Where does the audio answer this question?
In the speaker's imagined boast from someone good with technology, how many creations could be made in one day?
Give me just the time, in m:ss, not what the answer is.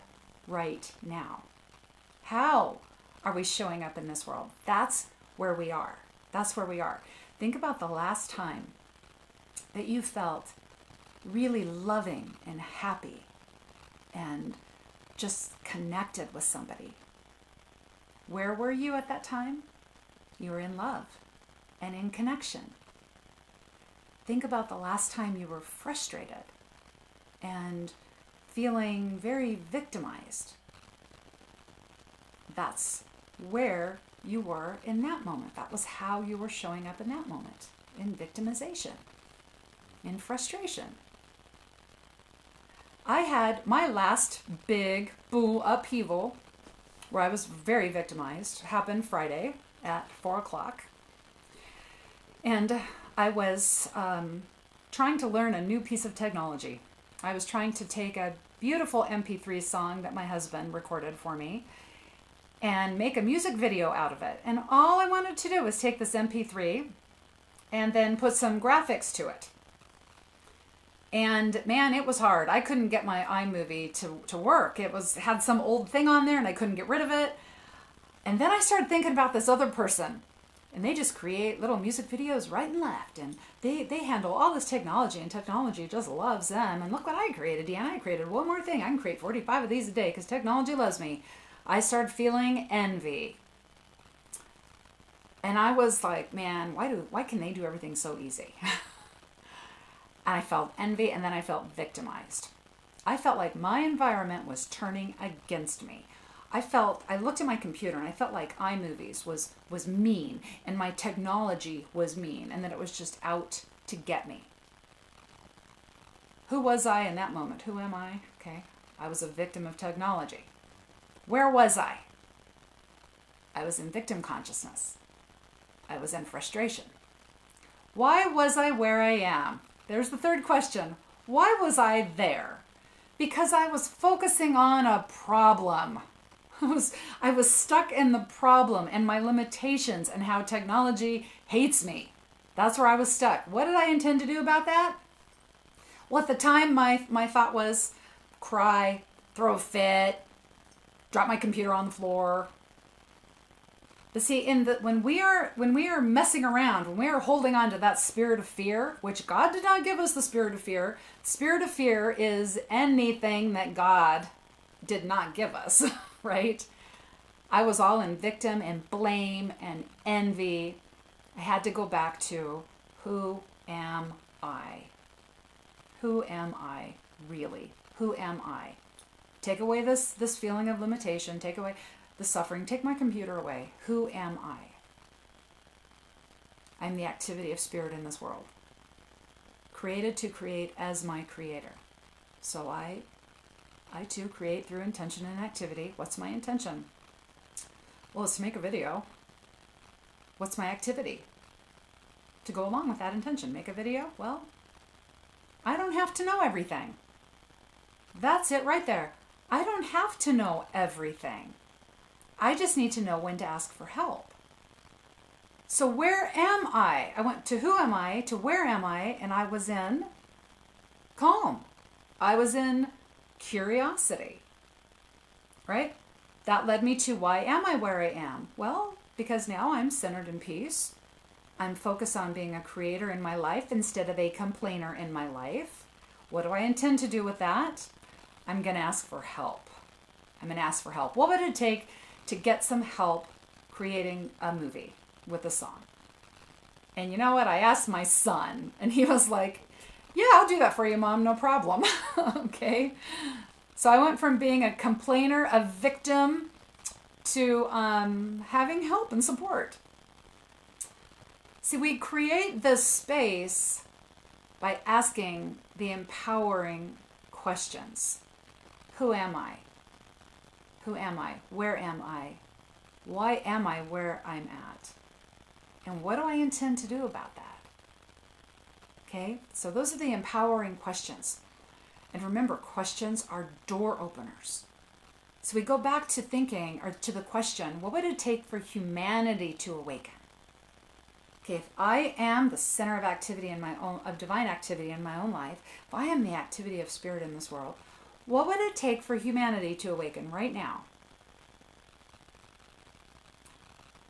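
1:29.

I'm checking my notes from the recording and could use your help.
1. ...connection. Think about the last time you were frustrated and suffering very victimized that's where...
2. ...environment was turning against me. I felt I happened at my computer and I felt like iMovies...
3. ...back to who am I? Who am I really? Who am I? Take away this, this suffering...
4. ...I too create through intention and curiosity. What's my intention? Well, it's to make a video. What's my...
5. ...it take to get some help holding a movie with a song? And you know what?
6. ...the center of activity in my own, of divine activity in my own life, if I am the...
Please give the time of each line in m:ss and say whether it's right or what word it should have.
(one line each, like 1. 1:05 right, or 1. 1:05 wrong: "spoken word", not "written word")
1. 0:22 wrong: "feeling", not "suffering"
2. 1:43 wrong: "looked", not "happened"
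3. 2:51 wrong: "feeling", not "suffering"
4. 3:13 wrong: "activity", not "curiosity"
5. 4:01 wrong: "creating", not "holding"
6. 4:52 right.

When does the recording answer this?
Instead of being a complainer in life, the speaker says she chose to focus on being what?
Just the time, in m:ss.
3:52.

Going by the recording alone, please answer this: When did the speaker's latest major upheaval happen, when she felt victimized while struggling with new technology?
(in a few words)
Friday at 4:00.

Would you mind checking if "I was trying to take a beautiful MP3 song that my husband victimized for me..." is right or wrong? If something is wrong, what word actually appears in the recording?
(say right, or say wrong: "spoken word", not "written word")
wrong: "recorded", not "victimized".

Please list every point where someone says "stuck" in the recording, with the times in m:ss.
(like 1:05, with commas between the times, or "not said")
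2:17, 2:23.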